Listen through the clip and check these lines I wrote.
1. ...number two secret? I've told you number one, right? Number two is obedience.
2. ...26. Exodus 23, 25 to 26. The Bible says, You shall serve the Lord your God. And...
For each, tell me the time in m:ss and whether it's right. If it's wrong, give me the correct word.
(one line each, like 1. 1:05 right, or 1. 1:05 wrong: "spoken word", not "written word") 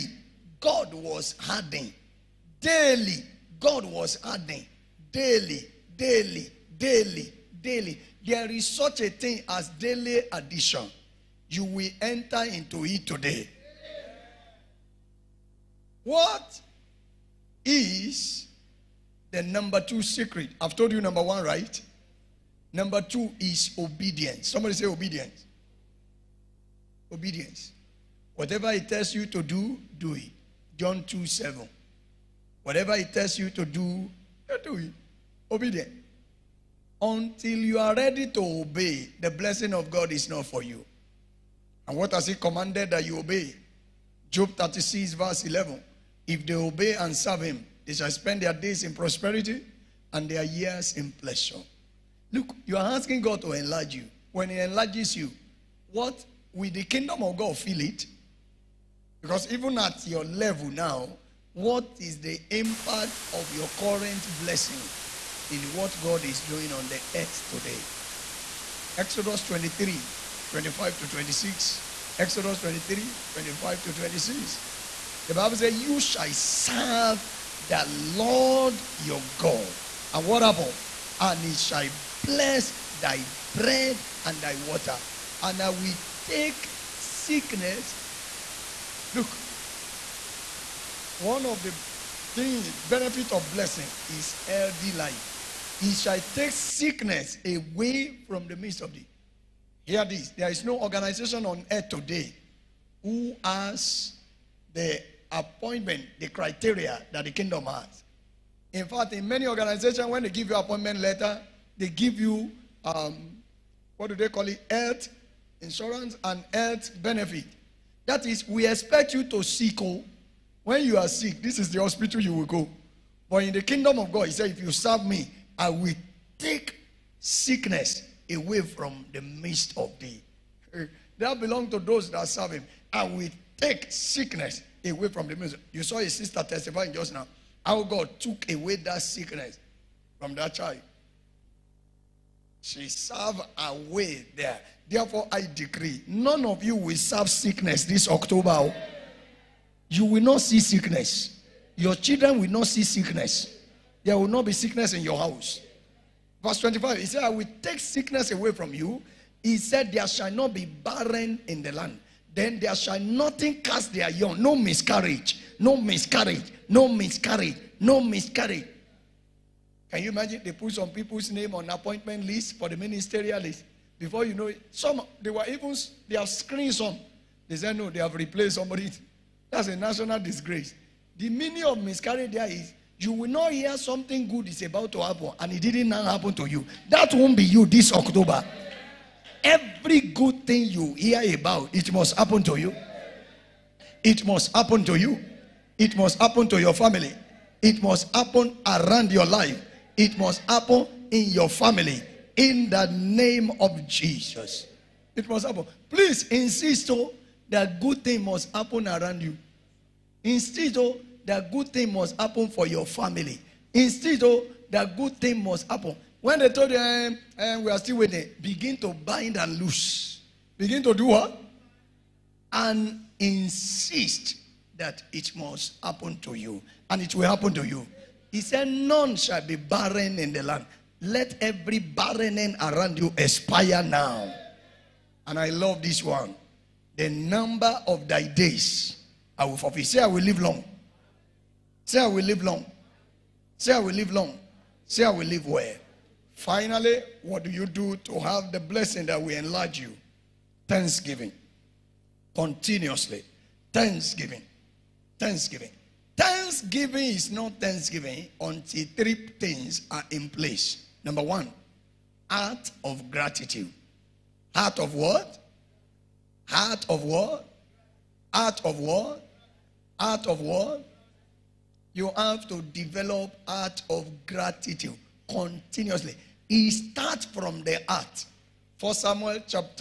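1. 0:19 right
2. 1:11 right.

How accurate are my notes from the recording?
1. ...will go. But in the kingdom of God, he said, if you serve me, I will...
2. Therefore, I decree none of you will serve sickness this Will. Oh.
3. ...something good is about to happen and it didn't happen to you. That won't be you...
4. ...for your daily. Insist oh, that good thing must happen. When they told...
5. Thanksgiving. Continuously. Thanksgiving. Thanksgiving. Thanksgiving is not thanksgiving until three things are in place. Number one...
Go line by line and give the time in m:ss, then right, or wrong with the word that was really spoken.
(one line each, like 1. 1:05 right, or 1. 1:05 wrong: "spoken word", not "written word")
1. 2:02 right
2. 2:24 wrong: "October", not "Will"
3. 3:03 right
4. 3:32 wrong: "family", not "daily"
5. 4:10 right.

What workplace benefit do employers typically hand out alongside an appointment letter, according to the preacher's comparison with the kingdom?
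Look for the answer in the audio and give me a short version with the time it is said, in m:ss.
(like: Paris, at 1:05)
Health insurance, at 1:54.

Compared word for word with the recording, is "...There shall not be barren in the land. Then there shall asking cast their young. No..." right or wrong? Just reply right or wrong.
wrong.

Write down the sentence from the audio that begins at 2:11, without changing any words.
That belong to those that serve him.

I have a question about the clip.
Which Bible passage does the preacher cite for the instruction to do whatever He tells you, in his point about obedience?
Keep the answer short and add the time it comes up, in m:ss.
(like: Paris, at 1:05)
John 2:7, at 0:30.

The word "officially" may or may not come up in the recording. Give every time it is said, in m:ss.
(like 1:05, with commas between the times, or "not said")
not said.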